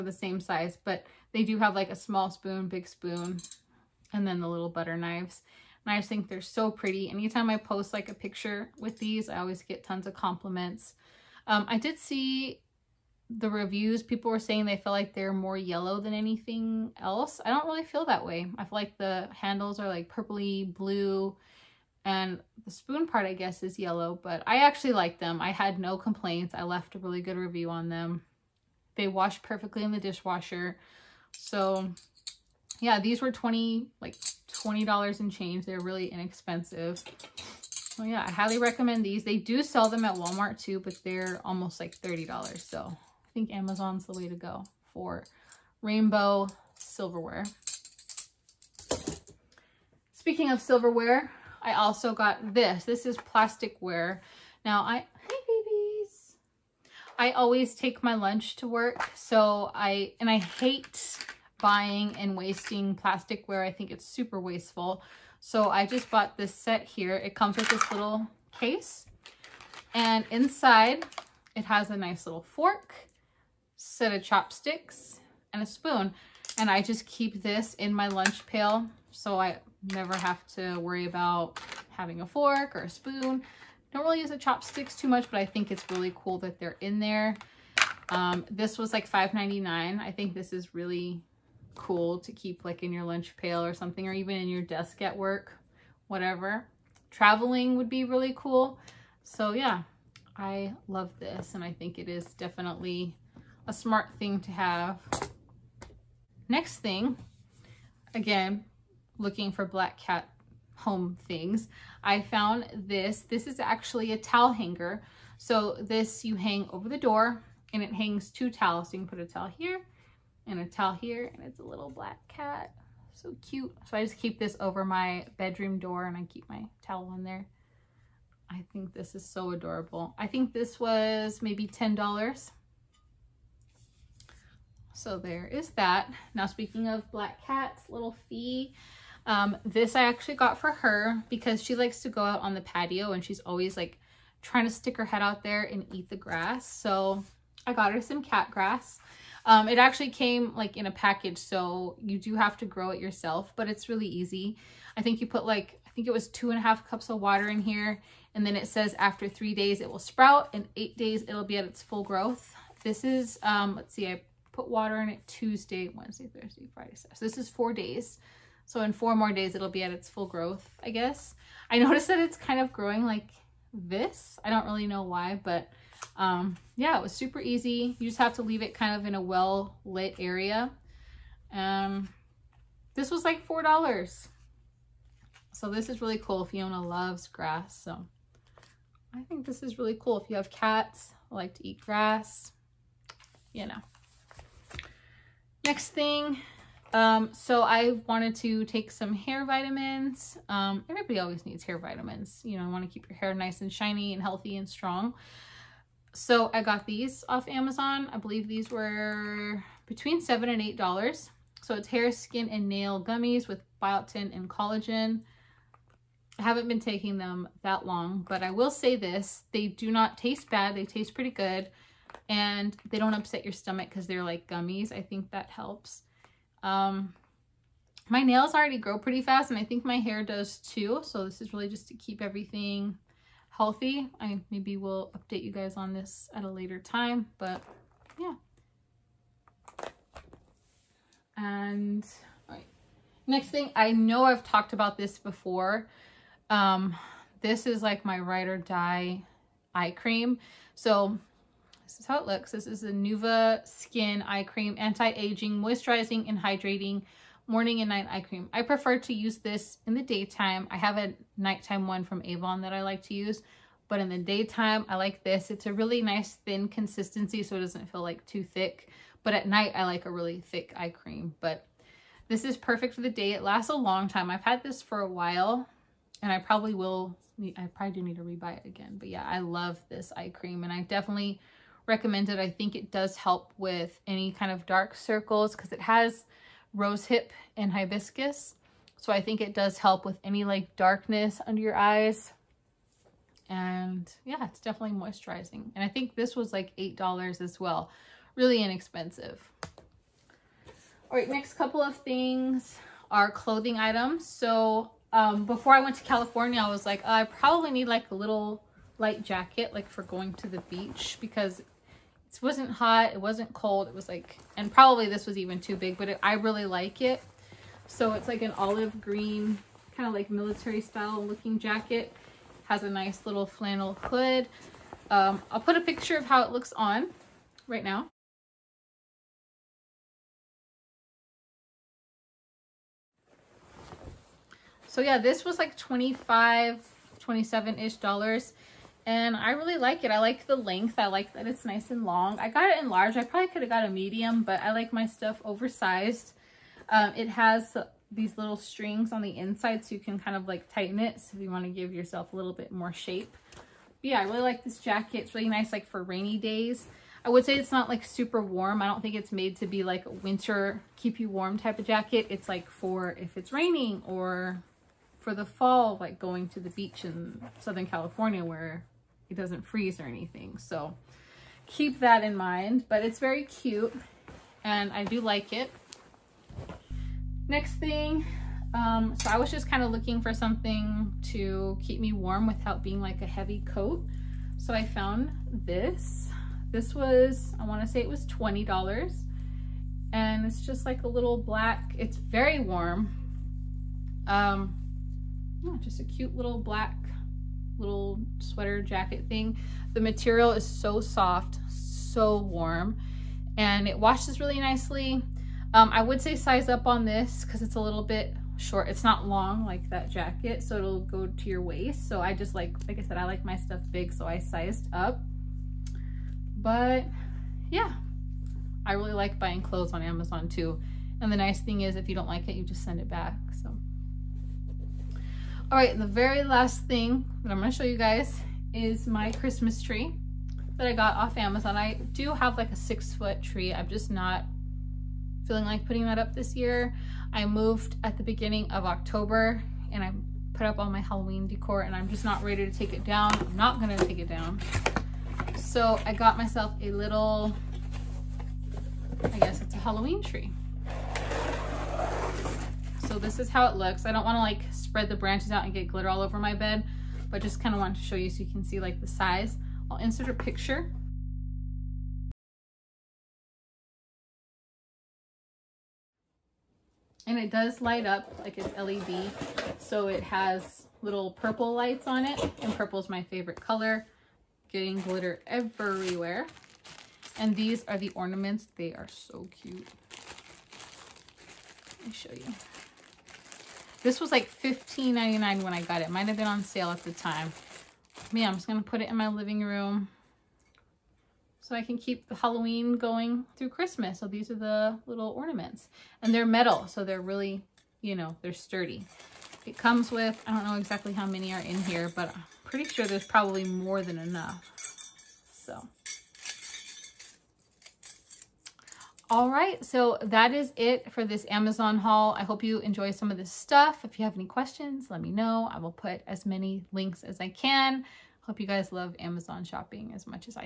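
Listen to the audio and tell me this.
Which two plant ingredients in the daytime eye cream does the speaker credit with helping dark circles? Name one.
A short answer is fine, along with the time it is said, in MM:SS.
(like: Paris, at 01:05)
rose hip, at 04:46.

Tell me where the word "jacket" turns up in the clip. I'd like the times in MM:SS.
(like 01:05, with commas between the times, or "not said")
05:09, 05:21, 05:54, 06:01, 06:38, 06:50.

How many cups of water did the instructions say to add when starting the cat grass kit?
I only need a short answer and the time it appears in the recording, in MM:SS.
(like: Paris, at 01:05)
2.5 cups, at 02:36.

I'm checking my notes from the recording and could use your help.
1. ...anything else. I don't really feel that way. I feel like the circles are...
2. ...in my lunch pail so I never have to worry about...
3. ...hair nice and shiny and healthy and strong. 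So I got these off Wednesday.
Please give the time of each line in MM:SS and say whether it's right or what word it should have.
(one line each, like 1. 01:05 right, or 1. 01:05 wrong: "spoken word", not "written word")
1. 00:16 wrong: "handles", not "circles"
2. 01:17 right
3. 03:23 wrong: "Amazon", not "Wednesday".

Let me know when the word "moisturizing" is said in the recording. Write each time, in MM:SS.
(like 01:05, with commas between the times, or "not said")
04:15, 04:54.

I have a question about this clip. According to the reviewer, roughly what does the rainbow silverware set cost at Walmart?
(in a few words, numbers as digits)
$30.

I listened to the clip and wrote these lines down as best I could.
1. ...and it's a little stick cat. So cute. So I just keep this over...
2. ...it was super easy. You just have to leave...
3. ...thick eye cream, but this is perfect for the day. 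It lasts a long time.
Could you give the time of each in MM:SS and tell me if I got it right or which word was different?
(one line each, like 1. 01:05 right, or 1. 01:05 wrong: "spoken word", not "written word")
1. 02:01 wrong: "black", not "stick"
2. 02:56 right
3. 04:30 right.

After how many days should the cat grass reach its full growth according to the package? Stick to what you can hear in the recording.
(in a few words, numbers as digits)
8 days.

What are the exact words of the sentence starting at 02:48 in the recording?
So in four more days, it'll be at its full growth, I guess.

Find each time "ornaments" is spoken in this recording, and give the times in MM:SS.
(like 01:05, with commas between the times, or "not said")
07:58, 08:15.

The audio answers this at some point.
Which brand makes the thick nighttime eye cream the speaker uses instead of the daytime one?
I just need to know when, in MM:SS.
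04:22.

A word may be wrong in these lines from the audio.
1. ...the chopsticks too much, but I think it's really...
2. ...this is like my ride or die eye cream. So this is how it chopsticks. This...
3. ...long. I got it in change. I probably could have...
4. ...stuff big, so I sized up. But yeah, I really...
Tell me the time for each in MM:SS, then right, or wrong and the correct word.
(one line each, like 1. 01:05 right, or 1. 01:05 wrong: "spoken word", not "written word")
1. 01:24 right
2. 04:07 wrong: "looks", not "chopsticks"
3. 05:42 wrong: "large", not "change"
4. 06:53 right.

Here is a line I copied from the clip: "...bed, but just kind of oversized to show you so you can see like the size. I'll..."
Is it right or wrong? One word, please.
wrong.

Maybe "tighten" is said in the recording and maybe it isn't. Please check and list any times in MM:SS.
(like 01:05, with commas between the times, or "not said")
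05:50.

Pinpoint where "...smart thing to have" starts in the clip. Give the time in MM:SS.
01:43.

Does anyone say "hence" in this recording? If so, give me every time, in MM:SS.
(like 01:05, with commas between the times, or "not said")
not said.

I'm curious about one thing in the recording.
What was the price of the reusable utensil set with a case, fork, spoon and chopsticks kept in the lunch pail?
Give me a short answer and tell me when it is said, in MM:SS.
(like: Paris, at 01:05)
$5.99, at 01:29.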